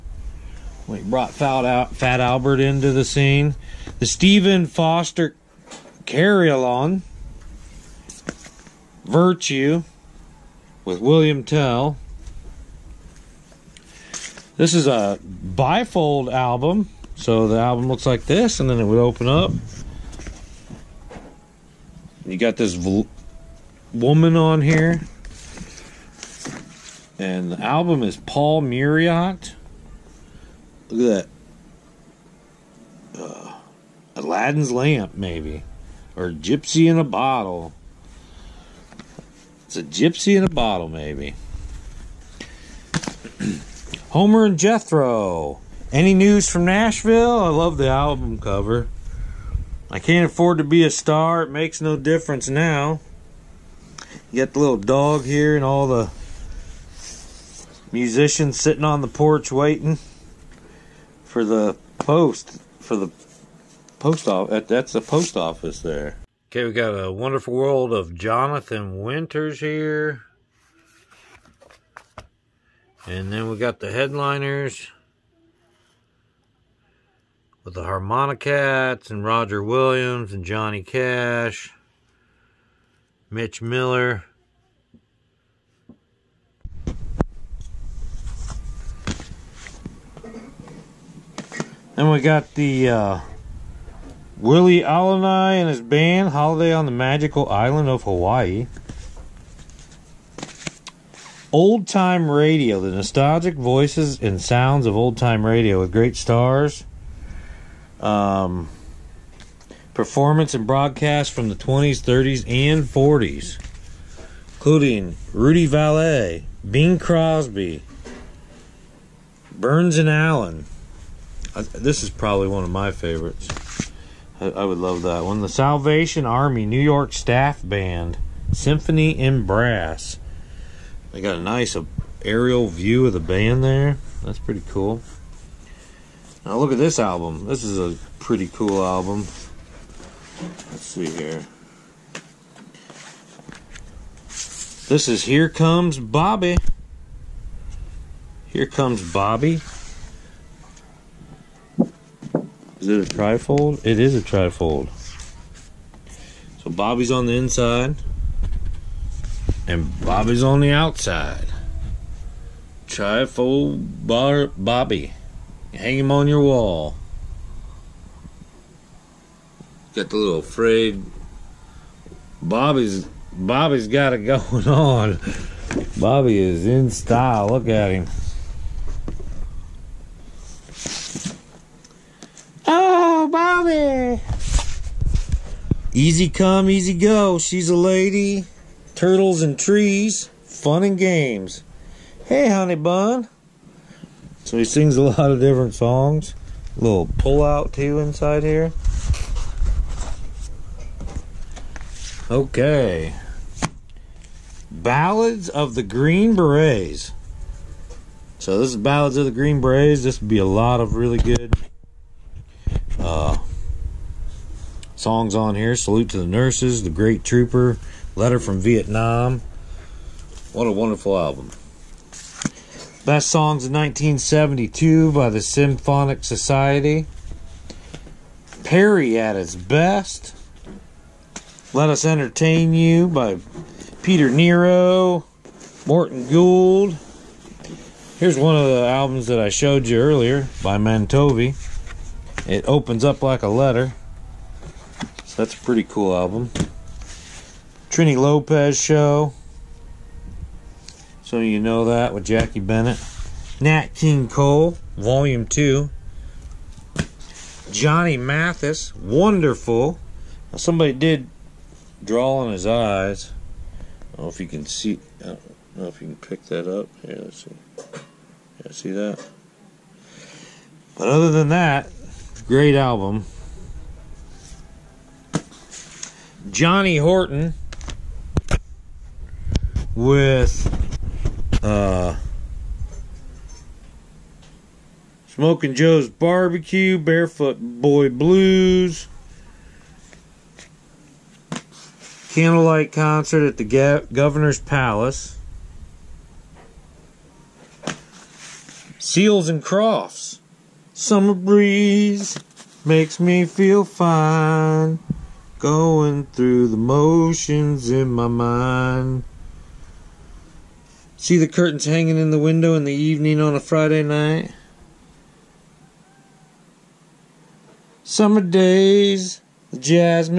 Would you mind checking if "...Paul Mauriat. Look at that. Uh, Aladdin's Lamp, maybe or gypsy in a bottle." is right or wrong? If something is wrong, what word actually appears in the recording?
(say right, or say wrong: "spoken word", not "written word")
right.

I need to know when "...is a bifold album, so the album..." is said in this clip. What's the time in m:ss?
0:14.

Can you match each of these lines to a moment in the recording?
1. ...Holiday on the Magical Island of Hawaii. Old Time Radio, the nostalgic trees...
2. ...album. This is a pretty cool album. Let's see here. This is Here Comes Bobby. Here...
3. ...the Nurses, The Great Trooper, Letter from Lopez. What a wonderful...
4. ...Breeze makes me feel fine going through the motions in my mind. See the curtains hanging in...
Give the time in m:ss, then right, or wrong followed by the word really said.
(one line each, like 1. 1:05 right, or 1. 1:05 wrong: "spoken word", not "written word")
1. 1:36 wrong: "voices", not "trees"
2. 2:16 right
3. 3:36 wrong: "Vietnam", not "Lopez"
4. 5:01 right.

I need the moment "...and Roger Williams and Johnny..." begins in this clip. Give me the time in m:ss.
1:19.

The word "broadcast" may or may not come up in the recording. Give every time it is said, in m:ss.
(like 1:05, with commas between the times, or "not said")
1:50.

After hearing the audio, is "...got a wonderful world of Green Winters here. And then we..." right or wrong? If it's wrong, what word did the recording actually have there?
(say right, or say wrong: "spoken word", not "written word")
wrong: "Jonathan", not "Green".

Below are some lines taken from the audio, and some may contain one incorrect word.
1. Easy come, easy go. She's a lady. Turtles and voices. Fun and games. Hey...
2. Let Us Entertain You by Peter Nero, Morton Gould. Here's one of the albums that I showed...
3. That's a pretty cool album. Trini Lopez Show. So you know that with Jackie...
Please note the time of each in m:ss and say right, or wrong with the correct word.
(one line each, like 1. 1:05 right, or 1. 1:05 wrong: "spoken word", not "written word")
1. 3:05 wrong: "trees", not "voices"
2. 3:51 right
3. 4:05 right.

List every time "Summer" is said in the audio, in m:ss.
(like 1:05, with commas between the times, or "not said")
5:00, 5:18.